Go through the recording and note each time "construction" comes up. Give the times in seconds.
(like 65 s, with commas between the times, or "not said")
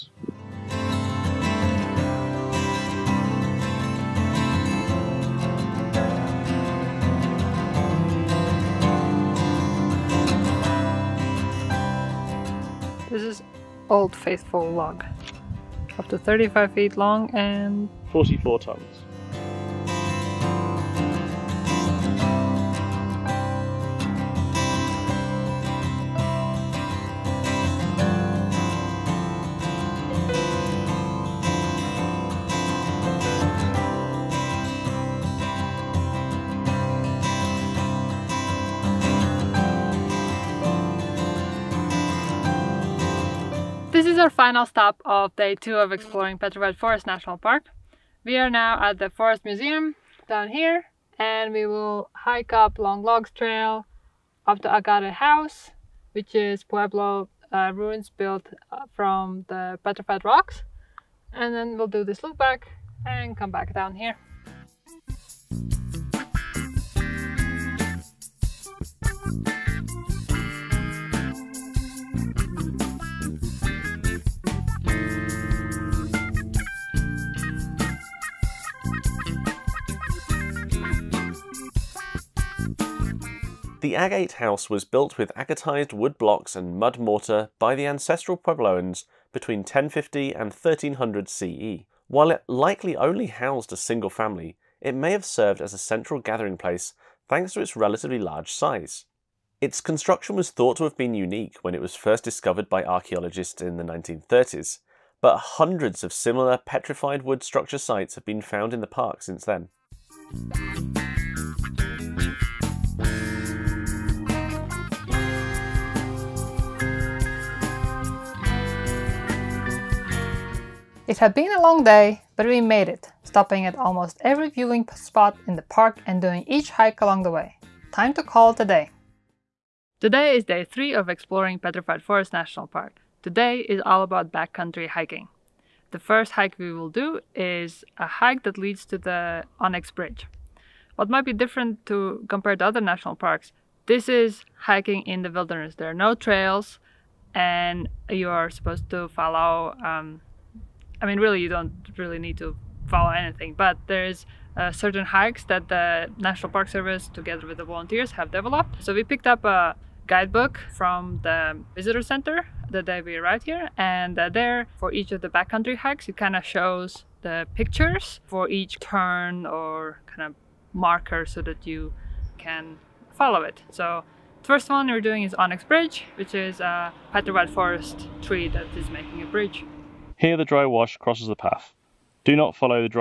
99 s.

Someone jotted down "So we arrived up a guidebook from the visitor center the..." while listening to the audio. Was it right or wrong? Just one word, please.
wrong.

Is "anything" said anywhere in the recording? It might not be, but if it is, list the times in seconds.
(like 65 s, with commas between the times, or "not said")
153 s.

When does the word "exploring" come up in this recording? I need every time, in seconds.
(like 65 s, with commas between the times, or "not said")
45 s, 131 s.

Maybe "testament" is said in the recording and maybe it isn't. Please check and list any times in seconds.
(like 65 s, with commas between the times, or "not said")
not said.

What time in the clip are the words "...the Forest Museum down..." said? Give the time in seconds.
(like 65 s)
48 s.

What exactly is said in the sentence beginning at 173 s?
So the first one we're doing is Onyx Bridge, which is a petrified forest tree that is making a bridge.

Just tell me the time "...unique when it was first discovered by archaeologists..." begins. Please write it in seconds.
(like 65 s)
101 s.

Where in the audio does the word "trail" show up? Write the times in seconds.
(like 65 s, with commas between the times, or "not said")
53 s, 146 s.